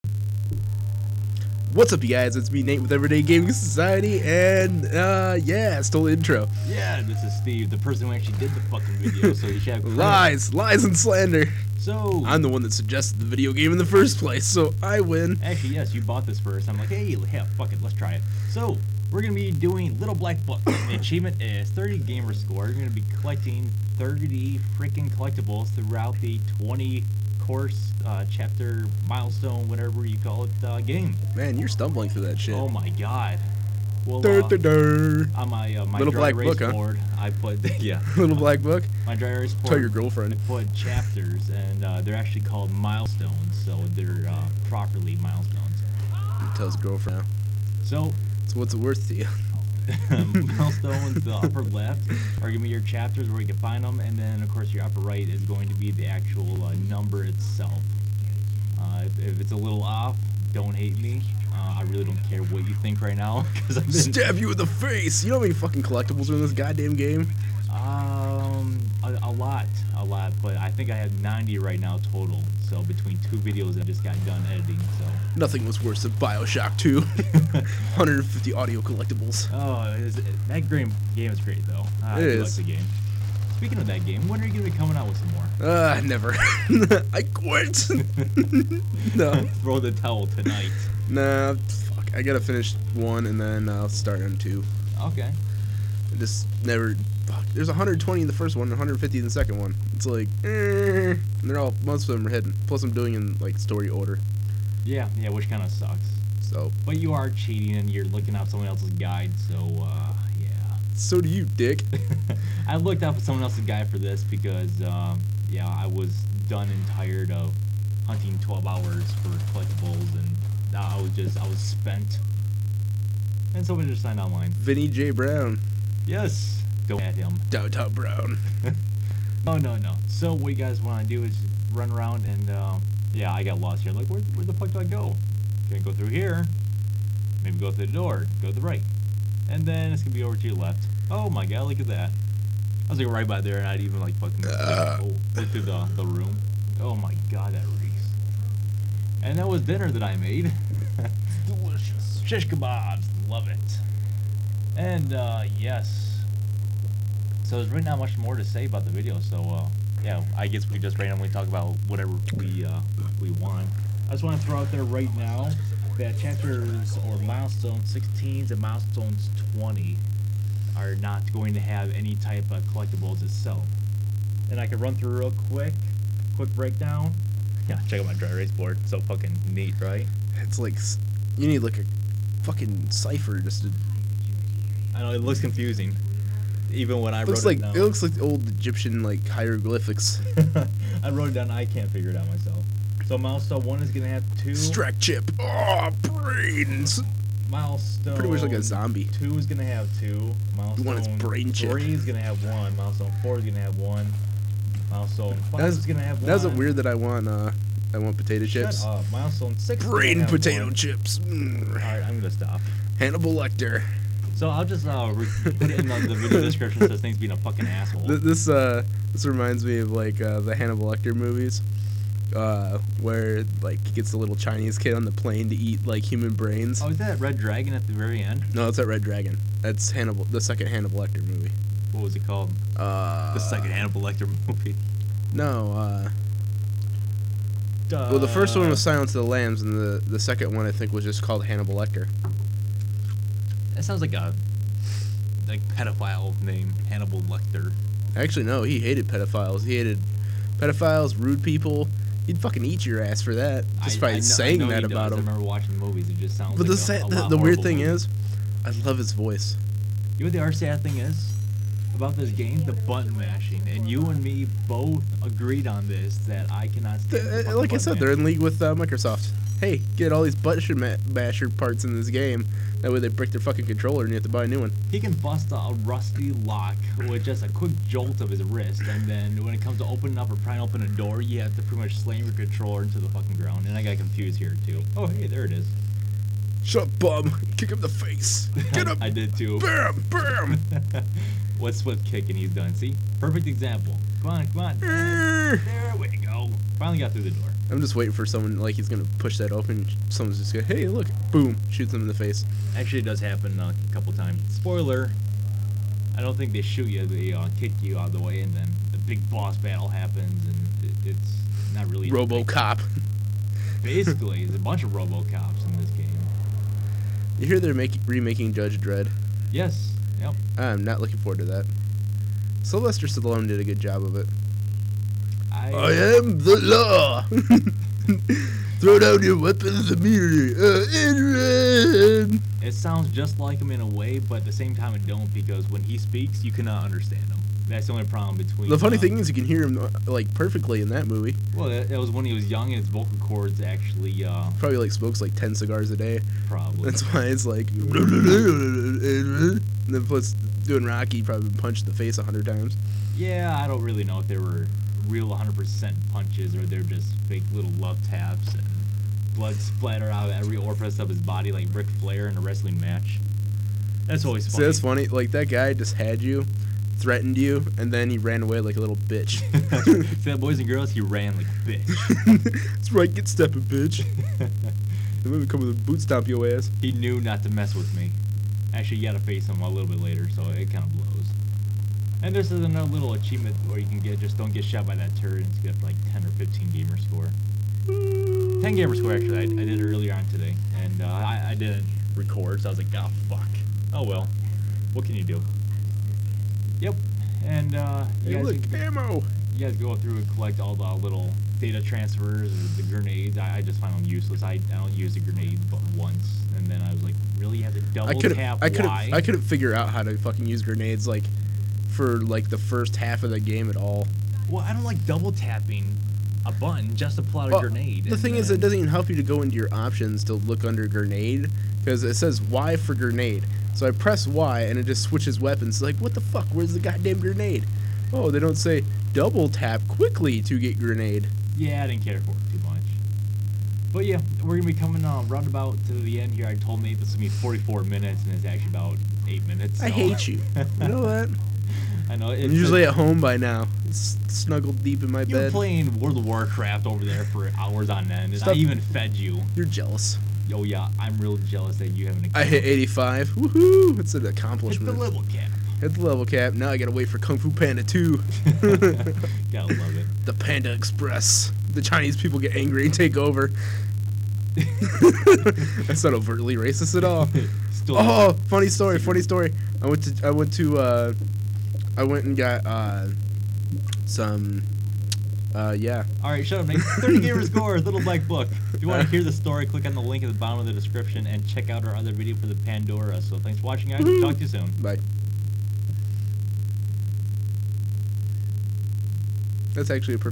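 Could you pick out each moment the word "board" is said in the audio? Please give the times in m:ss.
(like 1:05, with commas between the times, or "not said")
0:39, 2:58.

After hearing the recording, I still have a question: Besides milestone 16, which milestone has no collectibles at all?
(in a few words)
20.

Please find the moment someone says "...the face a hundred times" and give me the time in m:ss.
5:51.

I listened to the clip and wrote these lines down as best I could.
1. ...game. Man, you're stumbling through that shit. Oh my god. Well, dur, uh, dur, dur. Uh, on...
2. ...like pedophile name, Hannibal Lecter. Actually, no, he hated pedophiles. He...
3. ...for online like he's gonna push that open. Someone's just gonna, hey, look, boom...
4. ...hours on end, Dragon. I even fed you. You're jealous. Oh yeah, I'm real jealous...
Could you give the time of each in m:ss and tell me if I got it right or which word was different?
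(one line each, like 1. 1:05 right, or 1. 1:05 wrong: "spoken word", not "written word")
1. 0:30 right
2. 4:05 right
3. 4:58 wrong: "someone", not "online"
4. 7:27 wrong: "Stop", not "Dragon".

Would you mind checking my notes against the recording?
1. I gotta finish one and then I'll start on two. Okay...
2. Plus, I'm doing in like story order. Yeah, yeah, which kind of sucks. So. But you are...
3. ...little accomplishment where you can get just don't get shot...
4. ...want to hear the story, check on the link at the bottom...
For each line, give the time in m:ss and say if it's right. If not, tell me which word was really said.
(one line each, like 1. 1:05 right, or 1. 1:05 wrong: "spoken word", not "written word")
1. 1:32 right
2. 1:42 right
3. 6:22 wrong: "achievement", not "accomplishment"
4. 7:58 wrong: "click", not "check".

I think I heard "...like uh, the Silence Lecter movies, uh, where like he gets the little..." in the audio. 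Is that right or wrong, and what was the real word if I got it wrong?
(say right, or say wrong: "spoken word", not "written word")
wrong: "Hannibal", not "Silence".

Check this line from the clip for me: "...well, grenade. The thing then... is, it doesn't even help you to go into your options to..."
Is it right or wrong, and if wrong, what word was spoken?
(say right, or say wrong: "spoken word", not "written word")
right.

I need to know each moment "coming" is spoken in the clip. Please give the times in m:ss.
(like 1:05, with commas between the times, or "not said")
1:24, 7:14.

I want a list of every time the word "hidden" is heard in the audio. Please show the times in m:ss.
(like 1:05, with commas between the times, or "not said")
1:42.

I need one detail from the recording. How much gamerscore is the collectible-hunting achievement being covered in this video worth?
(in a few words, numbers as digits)
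30.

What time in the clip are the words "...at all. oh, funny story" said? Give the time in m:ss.
7:46.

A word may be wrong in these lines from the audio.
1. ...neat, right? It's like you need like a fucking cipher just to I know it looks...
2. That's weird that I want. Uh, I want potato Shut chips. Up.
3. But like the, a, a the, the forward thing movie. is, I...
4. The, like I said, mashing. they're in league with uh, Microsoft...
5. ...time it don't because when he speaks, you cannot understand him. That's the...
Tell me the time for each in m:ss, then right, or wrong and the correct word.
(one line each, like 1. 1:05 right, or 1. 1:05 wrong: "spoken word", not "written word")
1. 2:59 right
2. 3:26 right
3. 4:16 wrong: "weird", not "forward"
4. 4:27 right
5. 5:34 right.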